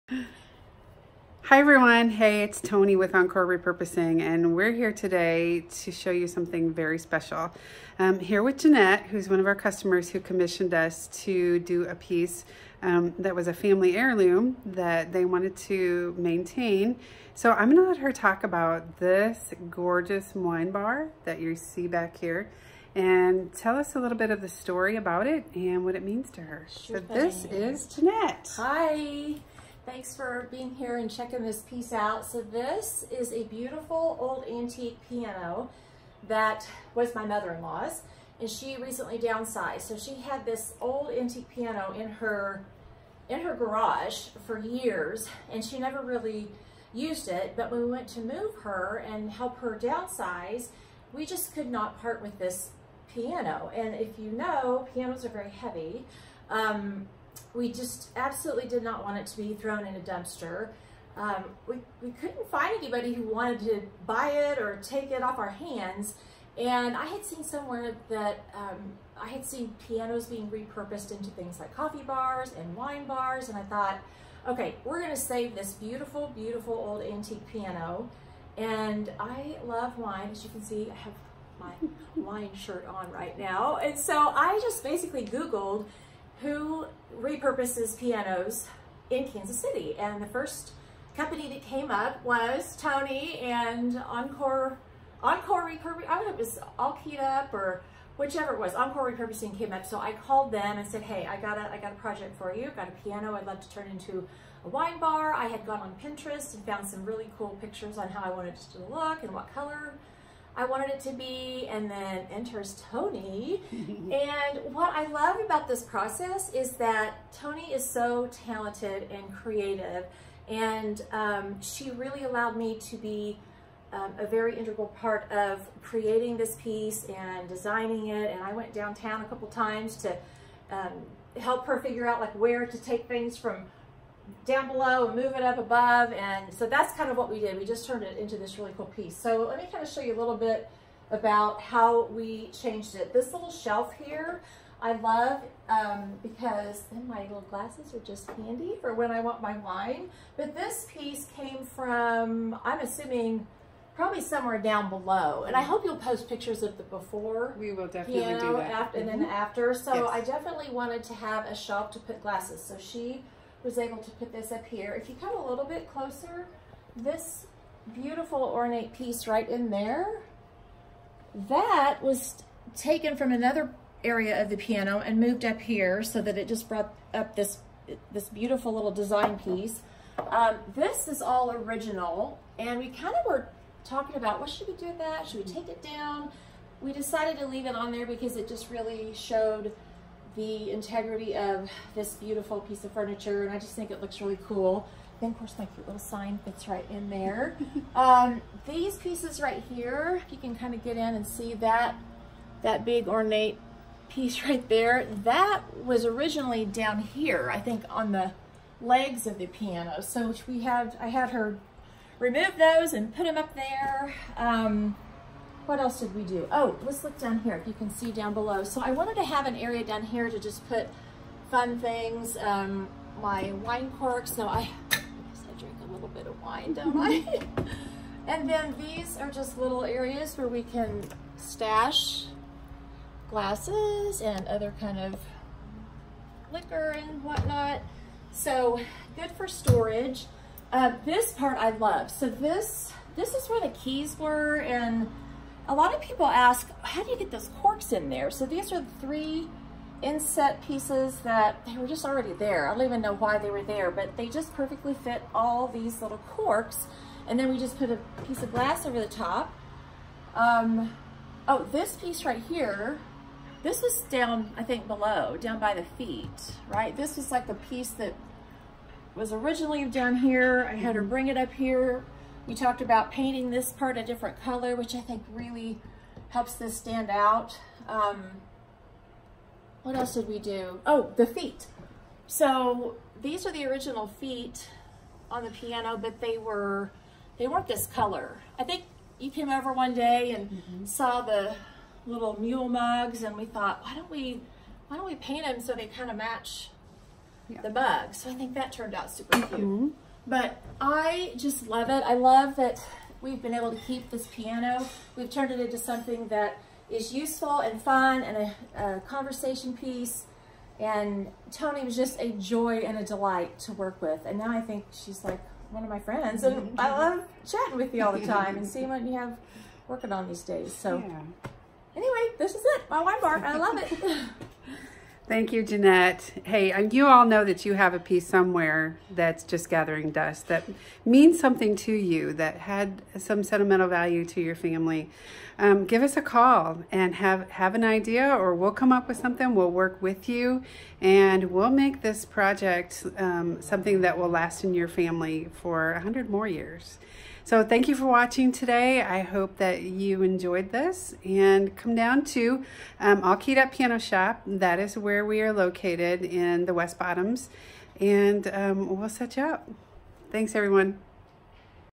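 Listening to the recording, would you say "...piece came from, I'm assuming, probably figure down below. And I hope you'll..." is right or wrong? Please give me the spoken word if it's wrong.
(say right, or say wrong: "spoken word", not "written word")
wrong: "somewhere", not "figure".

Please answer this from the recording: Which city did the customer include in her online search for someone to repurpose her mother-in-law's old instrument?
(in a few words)
Kansas City.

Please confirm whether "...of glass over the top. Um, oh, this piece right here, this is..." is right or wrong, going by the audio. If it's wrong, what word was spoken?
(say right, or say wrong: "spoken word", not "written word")
right.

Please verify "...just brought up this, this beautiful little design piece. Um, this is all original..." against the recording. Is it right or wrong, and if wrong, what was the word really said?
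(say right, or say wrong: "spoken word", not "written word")
right.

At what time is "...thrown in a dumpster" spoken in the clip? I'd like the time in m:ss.
0:59.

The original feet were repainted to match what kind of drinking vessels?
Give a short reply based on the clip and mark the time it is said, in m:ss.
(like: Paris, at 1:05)
Mule mugs, at 4:52.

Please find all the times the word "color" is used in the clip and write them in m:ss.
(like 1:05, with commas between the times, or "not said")
1:49, 4:34, 4:47.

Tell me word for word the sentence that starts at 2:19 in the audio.
So let me kind of show you a little bit about how we changed it.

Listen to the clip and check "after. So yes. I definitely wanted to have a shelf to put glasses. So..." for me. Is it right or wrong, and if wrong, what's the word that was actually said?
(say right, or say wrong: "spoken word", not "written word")
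right.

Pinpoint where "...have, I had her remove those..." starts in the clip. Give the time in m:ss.
3:30.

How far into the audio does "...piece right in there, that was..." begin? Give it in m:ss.
2:48.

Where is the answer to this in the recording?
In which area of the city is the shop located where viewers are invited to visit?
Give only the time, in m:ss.
5:56.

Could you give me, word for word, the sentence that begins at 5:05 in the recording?
We've turned it into something that is useful and fun and a, a conversation piece.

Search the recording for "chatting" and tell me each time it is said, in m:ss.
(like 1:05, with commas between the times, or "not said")
5:17.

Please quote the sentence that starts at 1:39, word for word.
So I called them and said, hey, I got a, I got a project for you.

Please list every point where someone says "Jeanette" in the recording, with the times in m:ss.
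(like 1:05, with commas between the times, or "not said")
0:08, 0:27, 5:25.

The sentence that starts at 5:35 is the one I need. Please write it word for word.
Um, give us a call and have, have an idea, or we'll come up with something.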